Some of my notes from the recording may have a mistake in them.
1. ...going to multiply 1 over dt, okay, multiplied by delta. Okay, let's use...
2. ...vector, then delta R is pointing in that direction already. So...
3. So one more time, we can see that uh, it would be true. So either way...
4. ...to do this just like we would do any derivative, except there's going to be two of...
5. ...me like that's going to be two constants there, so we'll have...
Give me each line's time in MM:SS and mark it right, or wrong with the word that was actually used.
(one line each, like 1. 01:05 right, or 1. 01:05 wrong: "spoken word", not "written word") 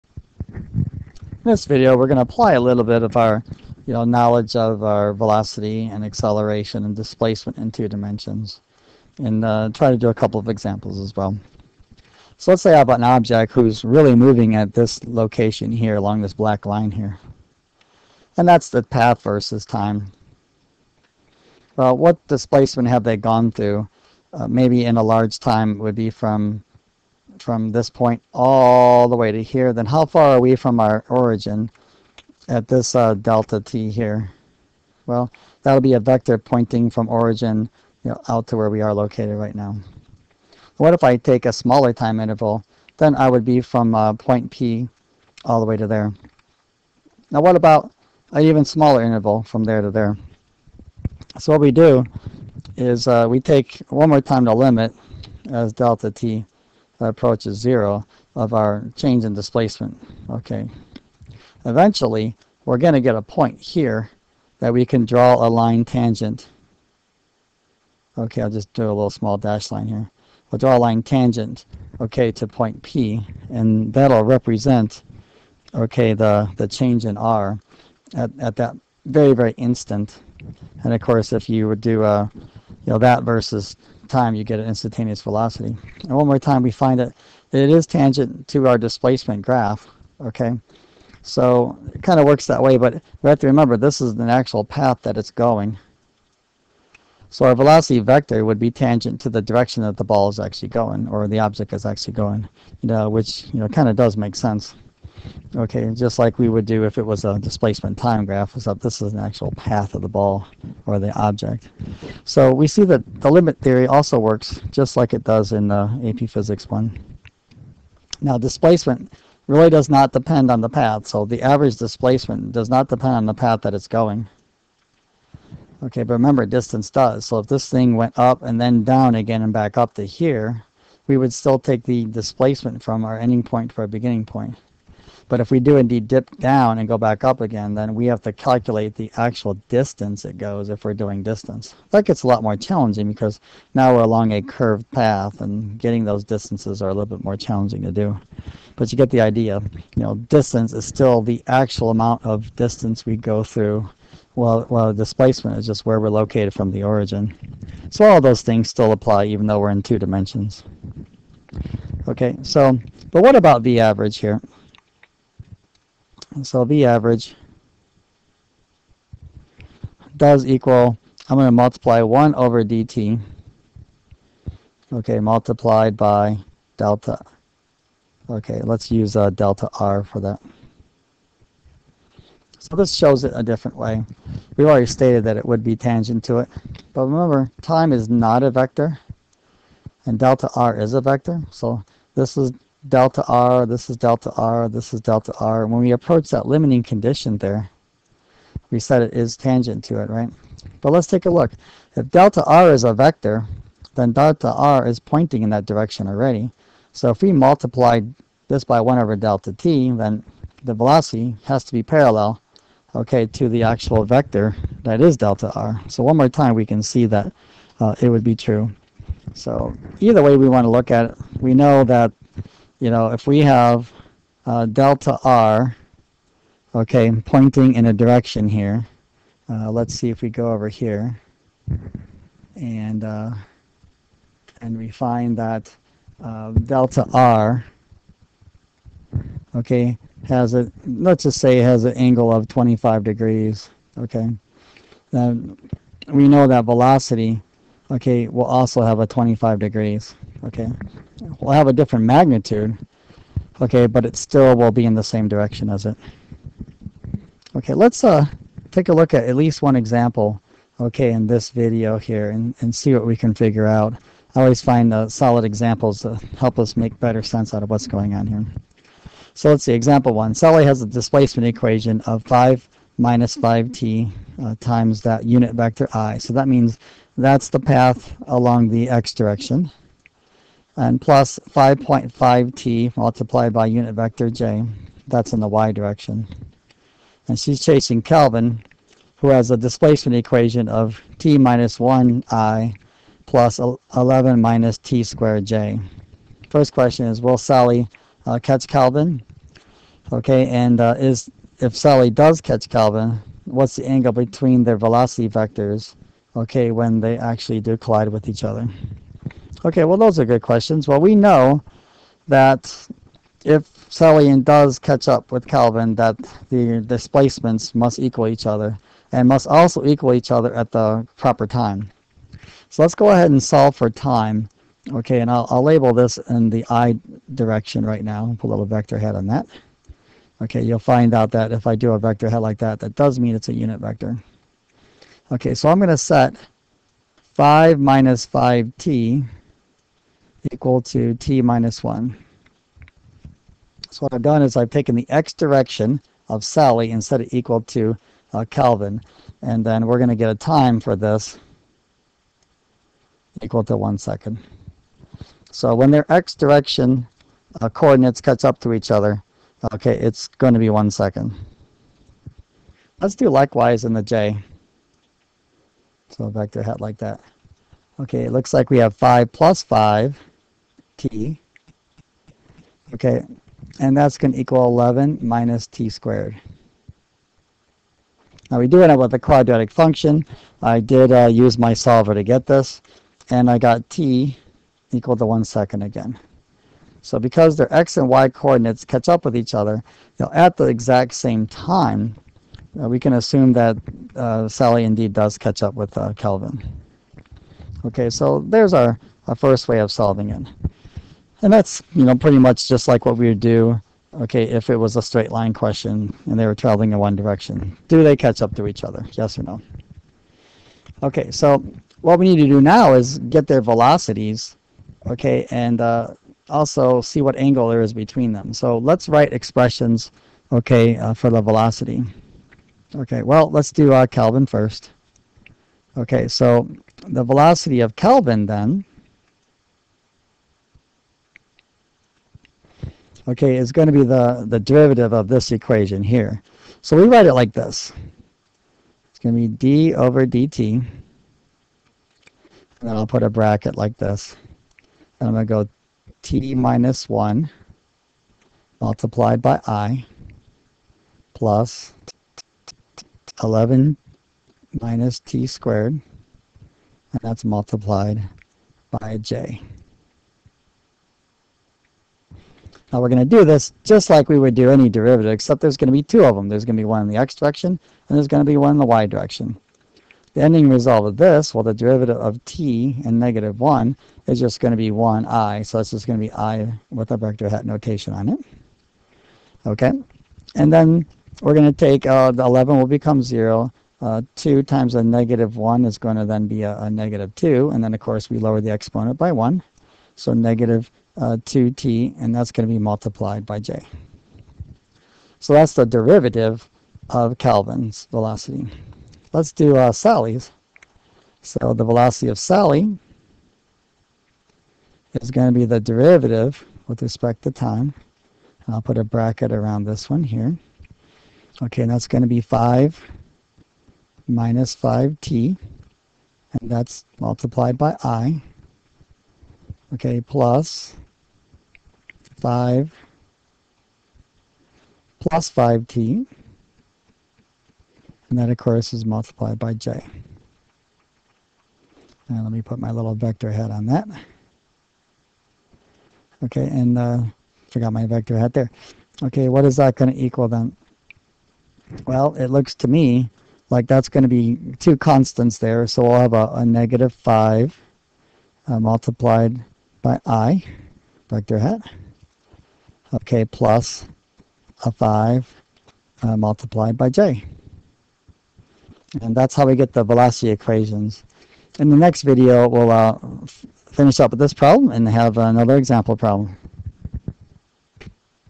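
1. 02:51 right
2. 03:22 right
3. 03:35 right
4. 07:43 right
5. 09:02 right.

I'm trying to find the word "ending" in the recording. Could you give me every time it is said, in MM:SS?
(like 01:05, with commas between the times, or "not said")
02:13, 07:50.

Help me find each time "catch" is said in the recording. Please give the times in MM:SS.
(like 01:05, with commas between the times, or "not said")
04:58, 05:02, 05:14, 06:28, 06:35, 06:48.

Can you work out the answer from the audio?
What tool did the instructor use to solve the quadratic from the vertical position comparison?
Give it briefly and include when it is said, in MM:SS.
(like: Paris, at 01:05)
solver, at 06:21.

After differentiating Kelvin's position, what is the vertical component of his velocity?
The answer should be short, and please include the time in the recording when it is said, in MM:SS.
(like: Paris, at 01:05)
-2t, at 08:10.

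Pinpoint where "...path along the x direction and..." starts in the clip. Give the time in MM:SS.
04:37.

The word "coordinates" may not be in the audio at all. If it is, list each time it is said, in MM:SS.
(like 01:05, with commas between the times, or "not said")
05:57, 06:28.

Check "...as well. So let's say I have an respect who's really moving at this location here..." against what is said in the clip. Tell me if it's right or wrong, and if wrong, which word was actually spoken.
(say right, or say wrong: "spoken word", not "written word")
wrong: "object", not "respect".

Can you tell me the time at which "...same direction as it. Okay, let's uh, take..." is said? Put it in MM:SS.
04:15.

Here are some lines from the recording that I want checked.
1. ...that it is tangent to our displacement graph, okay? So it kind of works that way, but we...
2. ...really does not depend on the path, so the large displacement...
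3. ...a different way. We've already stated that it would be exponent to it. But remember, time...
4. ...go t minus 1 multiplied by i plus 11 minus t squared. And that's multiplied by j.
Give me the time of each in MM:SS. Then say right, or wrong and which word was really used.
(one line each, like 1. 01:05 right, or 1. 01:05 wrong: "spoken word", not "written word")
1. 01:26 right
2. 01:59 wrong: "average", not "large"
3. 03:03 wrong: "tangent", not "exponent"
4. 07:25 right.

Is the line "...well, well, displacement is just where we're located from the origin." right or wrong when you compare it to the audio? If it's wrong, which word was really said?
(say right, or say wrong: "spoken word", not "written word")
right.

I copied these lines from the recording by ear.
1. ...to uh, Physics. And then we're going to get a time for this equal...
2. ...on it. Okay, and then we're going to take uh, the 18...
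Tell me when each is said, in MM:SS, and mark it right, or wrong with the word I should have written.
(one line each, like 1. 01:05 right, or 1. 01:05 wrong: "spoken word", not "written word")
1. 05:47 wrong: "Kelvin", not "Physics"
2. 07:58 wrong: "11", not "18".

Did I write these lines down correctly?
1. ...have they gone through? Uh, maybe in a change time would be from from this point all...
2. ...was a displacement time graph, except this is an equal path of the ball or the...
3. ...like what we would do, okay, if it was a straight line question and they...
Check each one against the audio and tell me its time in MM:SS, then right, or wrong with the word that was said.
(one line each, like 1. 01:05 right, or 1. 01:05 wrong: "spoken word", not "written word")
1. 00:22 wrong: "large", not "change"
2. 01:47 wrong: "actual", not "equal"
3. 06:42 right.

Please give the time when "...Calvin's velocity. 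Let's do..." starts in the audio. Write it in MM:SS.
08:17.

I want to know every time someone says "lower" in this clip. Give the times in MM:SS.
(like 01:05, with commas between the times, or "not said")
08:08.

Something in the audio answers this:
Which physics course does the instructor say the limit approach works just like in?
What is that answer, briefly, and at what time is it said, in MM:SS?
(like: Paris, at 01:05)
AP Physics one, at 01:56.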